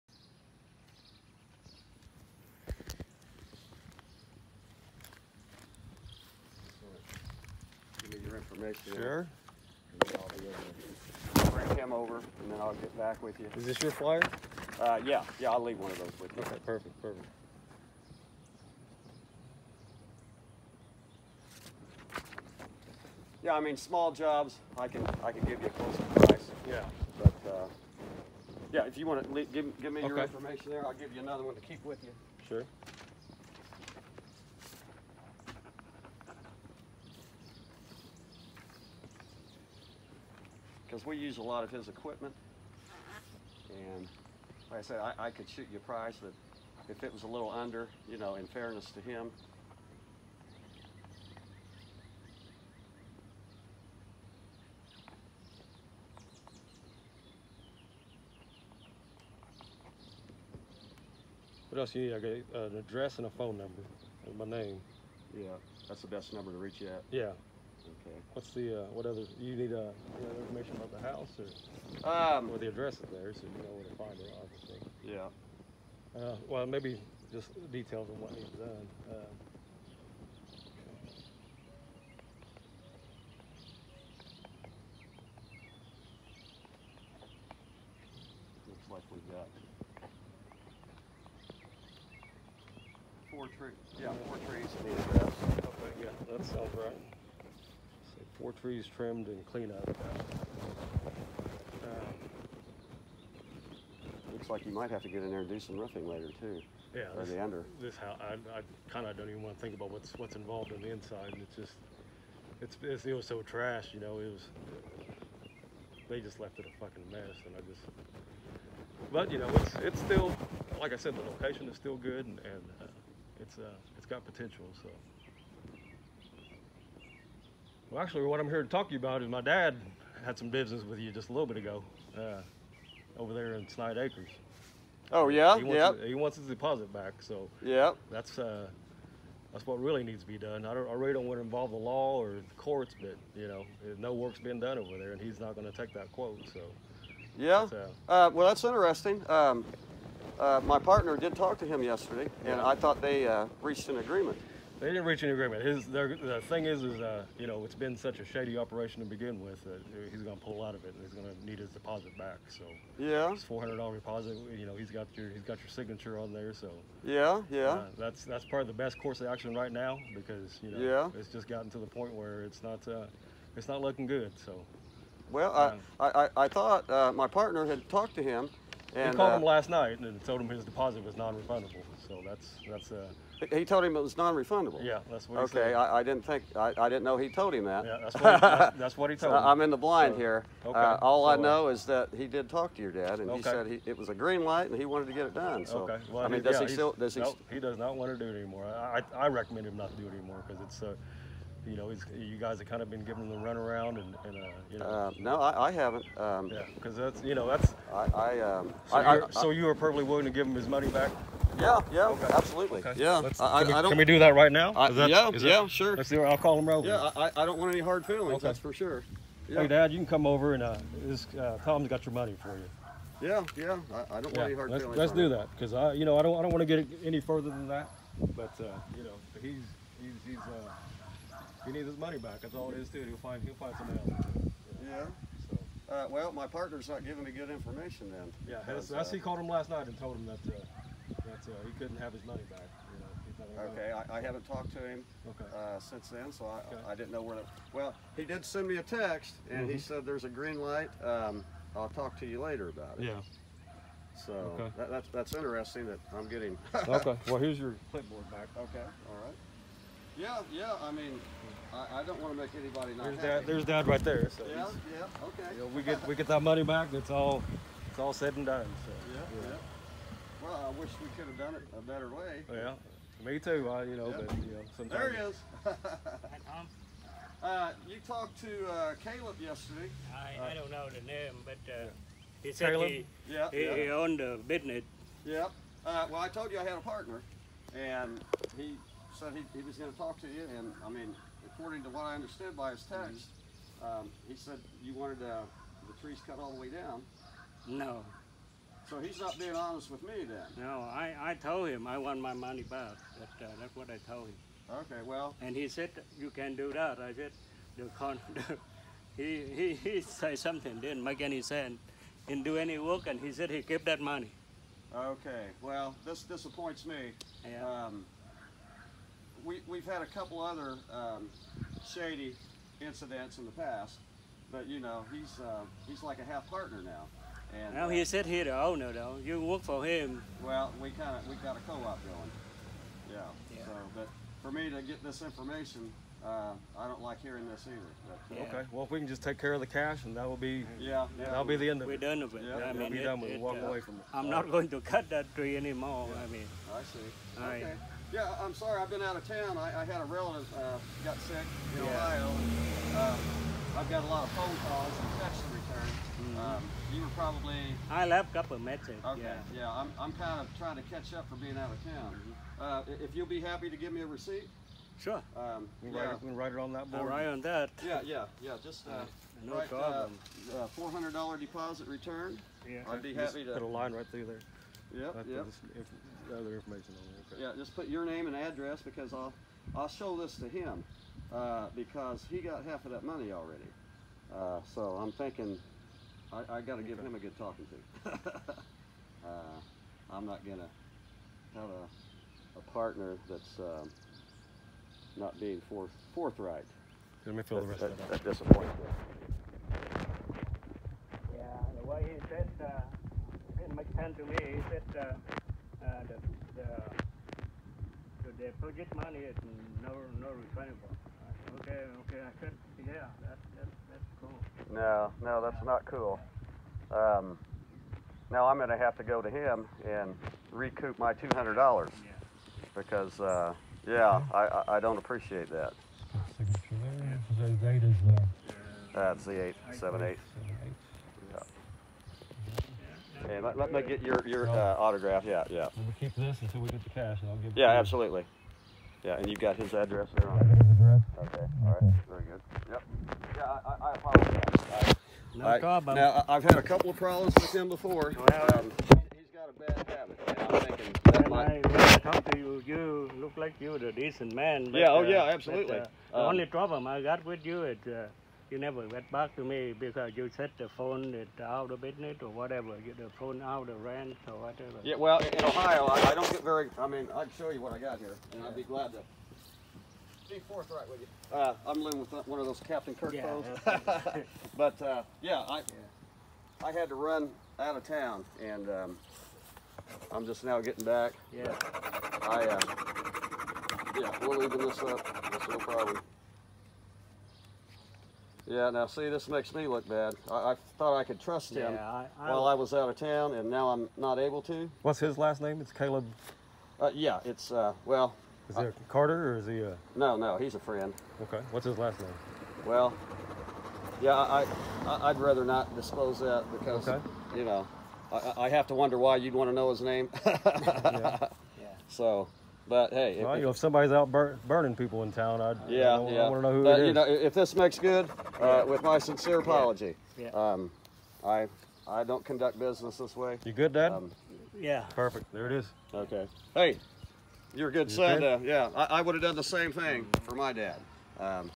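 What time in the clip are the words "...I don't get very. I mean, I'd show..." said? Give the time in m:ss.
7:46.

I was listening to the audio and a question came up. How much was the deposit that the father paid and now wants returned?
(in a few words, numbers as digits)
$400.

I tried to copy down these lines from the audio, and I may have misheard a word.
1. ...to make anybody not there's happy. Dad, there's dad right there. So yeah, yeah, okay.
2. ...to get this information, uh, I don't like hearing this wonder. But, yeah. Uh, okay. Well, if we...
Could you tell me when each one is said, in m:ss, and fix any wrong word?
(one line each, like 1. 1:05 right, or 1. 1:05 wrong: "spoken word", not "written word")
1. 4:22 right
2. 5:34 wrong: "either", not "wonder".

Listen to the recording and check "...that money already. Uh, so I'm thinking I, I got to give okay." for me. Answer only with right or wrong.
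right.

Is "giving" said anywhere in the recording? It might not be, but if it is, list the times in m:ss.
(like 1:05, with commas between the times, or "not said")
3:23, 3:57.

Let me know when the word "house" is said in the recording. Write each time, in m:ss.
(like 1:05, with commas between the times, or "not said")
1:10, 1:47.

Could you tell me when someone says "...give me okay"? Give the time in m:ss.
0:29.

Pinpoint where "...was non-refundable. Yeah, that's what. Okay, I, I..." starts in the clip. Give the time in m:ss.
3:04.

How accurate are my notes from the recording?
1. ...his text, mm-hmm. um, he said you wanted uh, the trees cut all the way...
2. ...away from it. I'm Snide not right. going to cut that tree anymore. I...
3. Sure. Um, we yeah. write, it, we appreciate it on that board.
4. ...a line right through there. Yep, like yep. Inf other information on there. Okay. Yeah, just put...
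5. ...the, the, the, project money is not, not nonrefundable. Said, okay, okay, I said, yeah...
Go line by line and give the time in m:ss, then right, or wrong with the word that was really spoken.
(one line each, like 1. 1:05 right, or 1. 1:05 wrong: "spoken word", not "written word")
1. 4:52 right
2. 5:43 wrong: "All", not "Snide"
3. 6:05 wrong: "write", not "appreciate"
4. 6:13 right
5. 6:46 wrong: "refundable", not "nonrefundable".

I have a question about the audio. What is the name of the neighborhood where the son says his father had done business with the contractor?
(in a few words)
Snide Acres.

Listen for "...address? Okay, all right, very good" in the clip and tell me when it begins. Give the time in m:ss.
7:20.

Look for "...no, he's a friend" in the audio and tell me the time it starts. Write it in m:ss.
8:20.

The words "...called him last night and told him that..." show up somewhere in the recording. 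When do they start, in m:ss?
3:59.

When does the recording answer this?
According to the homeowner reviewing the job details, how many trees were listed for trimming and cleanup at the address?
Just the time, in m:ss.
1:38.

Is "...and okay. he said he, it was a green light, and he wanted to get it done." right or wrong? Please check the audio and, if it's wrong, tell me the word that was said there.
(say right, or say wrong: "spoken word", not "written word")
right.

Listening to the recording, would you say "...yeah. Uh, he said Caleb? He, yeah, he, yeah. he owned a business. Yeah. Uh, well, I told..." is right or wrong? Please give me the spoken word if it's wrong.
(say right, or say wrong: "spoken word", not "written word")
right.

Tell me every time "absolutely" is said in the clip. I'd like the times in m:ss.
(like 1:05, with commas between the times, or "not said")
3:32, 7:17, 7:35.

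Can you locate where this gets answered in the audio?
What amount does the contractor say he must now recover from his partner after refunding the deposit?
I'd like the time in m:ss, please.
7:01.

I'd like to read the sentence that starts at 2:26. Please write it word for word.
So yeah, uh, uh, well, that's interesting.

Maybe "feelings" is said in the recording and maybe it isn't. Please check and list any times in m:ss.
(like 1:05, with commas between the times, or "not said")
3:38, 3:44.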